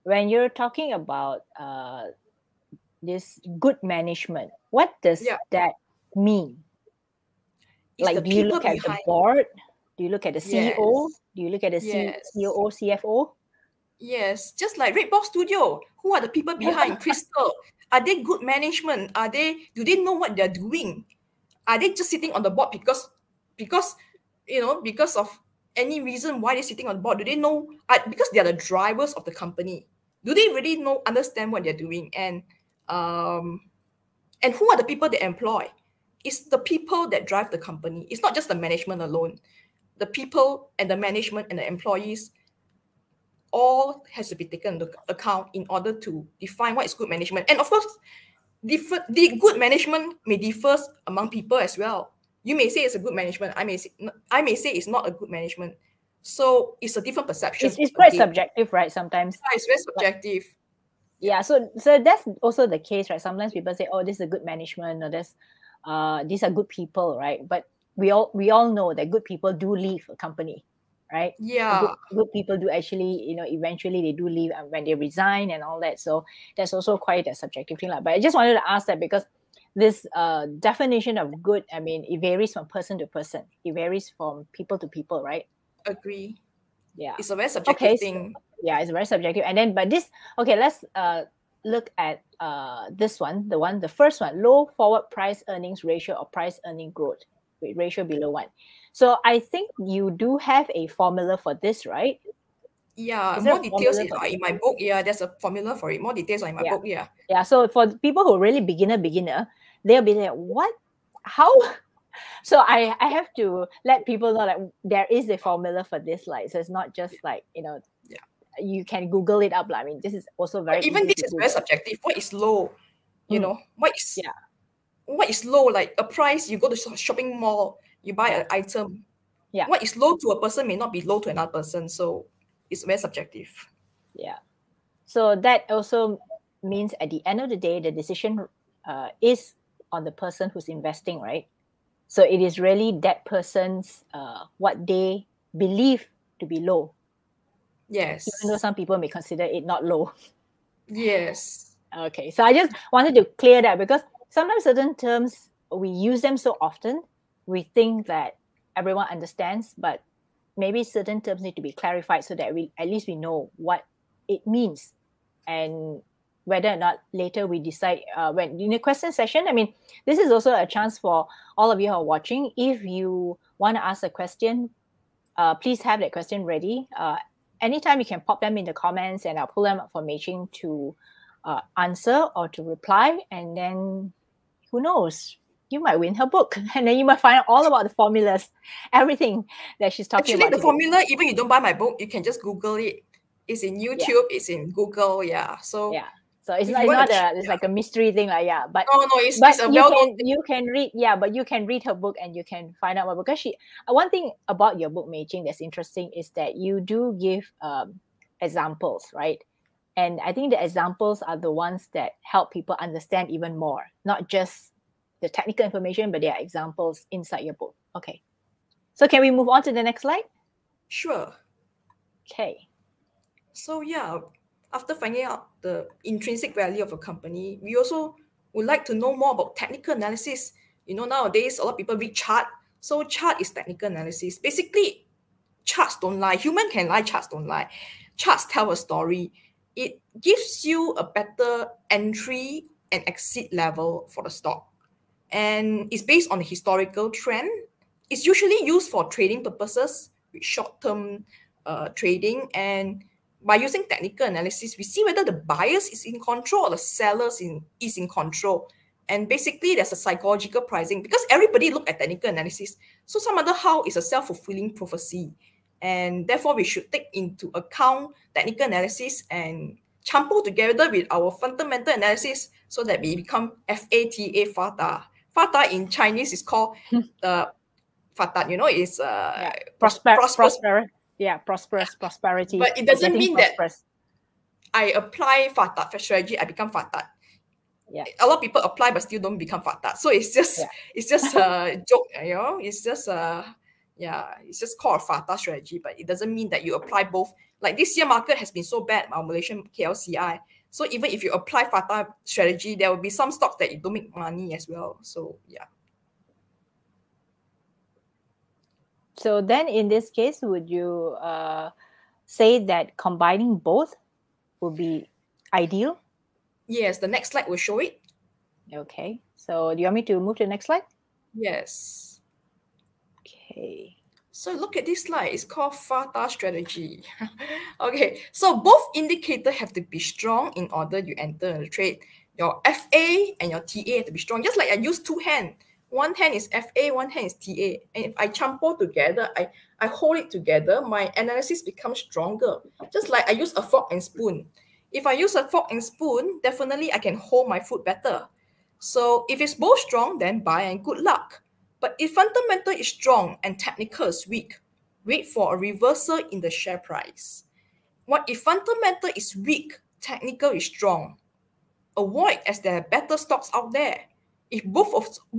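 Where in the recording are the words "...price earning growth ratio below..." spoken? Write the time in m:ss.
1:36.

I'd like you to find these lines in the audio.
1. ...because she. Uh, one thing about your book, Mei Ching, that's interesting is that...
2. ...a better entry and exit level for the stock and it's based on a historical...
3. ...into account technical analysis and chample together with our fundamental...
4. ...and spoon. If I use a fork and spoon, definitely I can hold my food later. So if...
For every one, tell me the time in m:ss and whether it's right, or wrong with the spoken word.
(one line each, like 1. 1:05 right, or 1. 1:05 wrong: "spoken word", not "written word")
1. 3:23 right
2. 4:00 right
3. 4:27 right
4. 5:43 wrong: "better", not "later".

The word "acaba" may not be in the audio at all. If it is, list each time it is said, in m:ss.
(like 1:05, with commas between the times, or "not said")
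not said.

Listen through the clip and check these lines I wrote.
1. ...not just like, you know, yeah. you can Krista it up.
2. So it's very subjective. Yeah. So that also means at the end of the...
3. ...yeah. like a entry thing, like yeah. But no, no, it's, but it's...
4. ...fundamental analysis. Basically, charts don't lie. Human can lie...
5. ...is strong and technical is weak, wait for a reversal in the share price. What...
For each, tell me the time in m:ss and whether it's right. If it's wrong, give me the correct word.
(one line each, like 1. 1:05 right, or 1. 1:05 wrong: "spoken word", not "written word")
1. 1:56 wrong: "Google", not "Krista"
2. 2:11 right
3. 3:17 wrong: "mystery", not "entry"
4. 3:53 wrong: "technical", not "fundamental"
5. 5:52 right.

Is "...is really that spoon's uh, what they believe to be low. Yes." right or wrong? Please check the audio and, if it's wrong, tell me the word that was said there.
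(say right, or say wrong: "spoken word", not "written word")
wrong: "person", not "spoon".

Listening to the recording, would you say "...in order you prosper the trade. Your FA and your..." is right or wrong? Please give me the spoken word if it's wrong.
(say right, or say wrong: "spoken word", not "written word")
wrong: "enter", not "prosper".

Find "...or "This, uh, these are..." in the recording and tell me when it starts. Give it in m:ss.
1:05.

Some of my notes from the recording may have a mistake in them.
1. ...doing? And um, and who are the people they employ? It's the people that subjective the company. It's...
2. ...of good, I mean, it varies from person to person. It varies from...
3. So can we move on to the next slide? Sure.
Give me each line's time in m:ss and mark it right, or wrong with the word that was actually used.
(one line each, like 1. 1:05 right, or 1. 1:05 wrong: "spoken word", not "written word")
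1. 0:31 wrong: "drive", not "subjective"
2. 1:21 right
3. 3:38 right.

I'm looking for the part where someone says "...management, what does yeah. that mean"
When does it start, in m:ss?
0:03.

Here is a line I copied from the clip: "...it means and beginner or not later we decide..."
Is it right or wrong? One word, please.
wrong.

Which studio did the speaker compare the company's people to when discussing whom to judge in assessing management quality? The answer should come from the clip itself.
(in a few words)
Red Box Studio.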